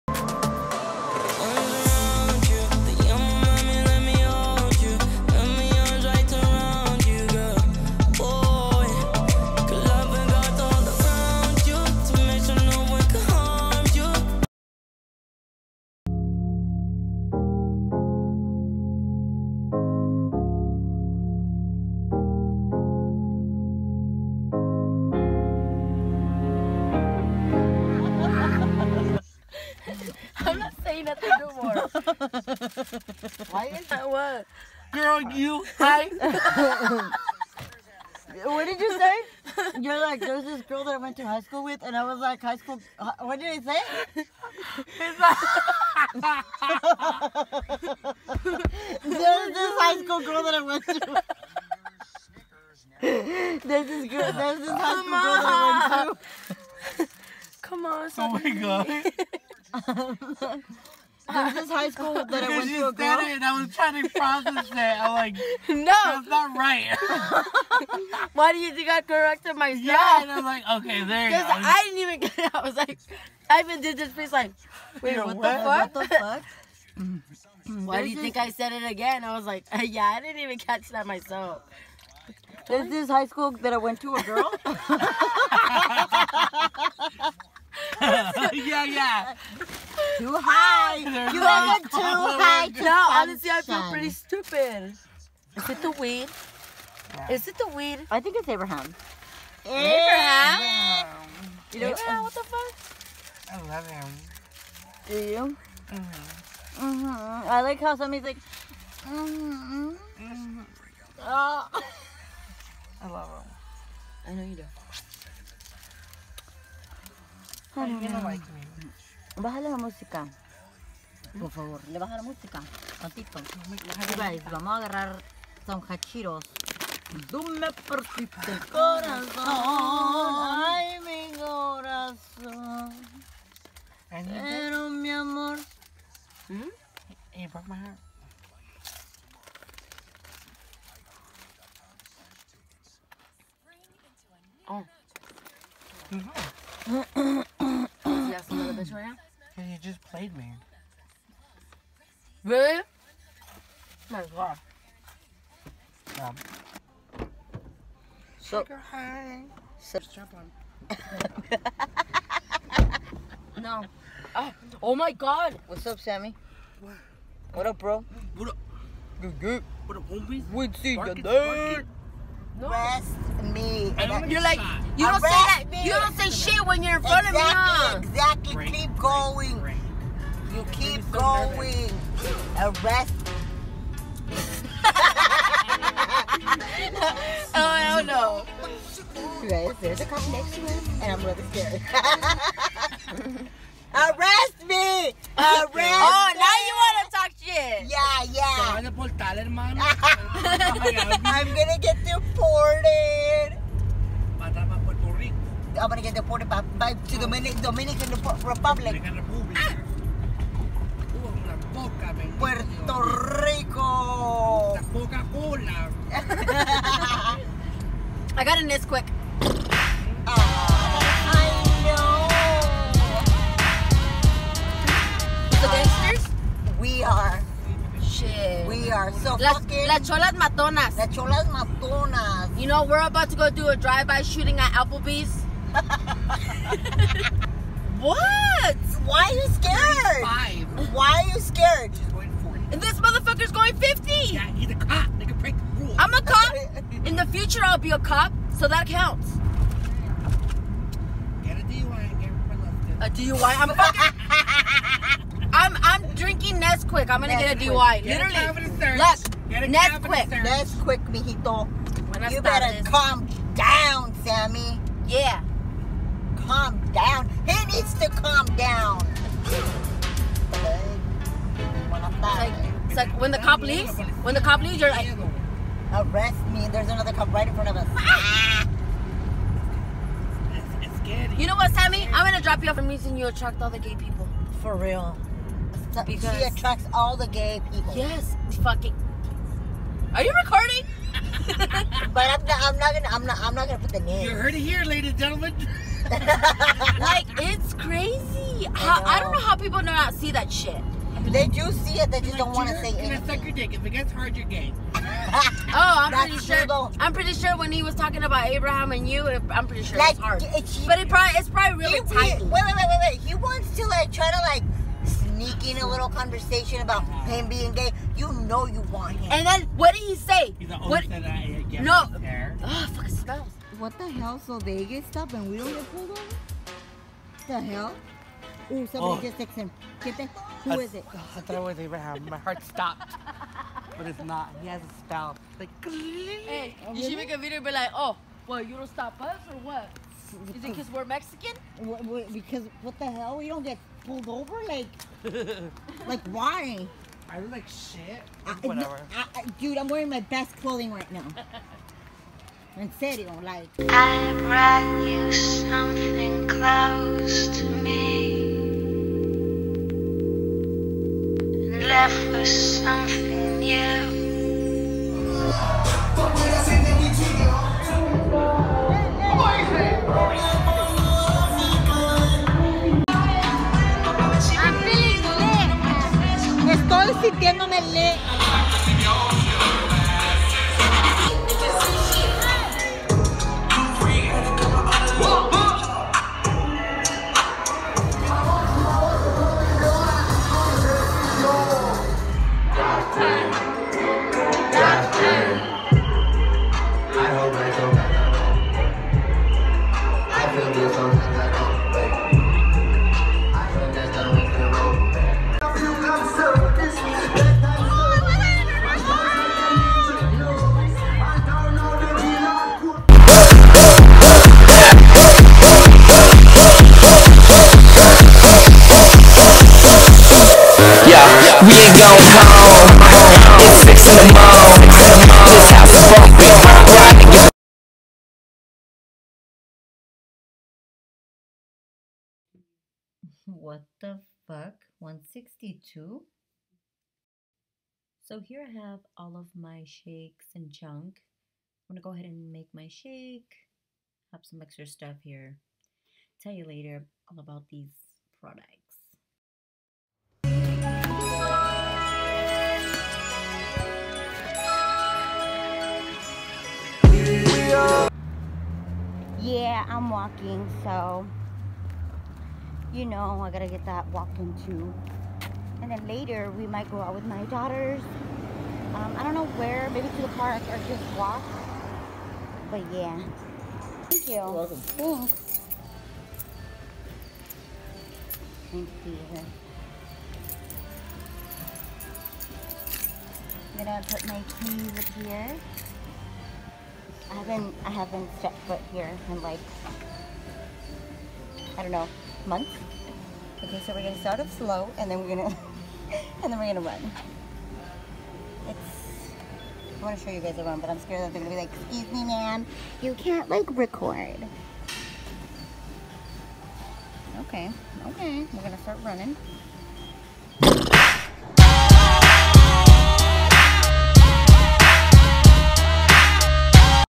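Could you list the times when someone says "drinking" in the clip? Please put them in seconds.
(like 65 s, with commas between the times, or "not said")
256 s.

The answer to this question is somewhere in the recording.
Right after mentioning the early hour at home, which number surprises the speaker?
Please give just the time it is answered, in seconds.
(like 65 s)
434 s.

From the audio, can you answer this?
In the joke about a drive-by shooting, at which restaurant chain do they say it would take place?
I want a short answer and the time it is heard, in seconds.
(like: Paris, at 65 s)
Applebee's, at 234 s.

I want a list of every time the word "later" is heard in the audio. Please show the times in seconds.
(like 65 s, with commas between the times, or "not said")
446 s, 466 s.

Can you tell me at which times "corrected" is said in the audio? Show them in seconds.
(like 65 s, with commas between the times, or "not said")
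69 s.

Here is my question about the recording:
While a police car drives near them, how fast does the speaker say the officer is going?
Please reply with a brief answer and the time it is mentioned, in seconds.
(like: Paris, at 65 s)
50, at 243 s.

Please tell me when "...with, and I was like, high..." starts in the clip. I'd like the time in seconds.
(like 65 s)
41 s.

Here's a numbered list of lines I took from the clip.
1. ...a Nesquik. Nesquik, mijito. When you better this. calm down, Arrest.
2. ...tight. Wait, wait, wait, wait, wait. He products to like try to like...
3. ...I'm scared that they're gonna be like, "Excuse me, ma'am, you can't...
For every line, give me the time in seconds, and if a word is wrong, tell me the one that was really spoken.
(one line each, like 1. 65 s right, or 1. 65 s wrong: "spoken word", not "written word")
1. 259 s wrong: "Sammy", not "Arrest"
2. 312 s wrong: "wants", not "products"
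3. 500 s right.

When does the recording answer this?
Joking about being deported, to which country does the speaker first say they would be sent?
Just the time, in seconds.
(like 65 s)
207 s.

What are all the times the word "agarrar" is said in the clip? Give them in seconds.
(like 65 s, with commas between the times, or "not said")
124 s.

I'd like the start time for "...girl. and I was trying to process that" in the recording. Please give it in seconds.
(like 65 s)
62 s.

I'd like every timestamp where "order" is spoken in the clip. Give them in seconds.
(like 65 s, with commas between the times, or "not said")
not said.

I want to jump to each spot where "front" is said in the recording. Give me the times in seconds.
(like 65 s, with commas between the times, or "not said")
177 s, 277 s.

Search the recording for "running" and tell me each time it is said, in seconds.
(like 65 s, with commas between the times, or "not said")
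509 s.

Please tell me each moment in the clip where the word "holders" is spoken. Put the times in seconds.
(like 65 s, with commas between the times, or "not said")
not said.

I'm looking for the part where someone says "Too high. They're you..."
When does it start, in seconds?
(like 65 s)
90 s.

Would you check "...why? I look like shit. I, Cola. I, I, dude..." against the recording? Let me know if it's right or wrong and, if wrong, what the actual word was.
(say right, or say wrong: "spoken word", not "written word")
wrong: "Whatever", not "Cola".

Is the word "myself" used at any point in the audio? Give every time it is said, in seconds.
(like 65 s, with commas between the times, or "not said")
69 s, 81 s.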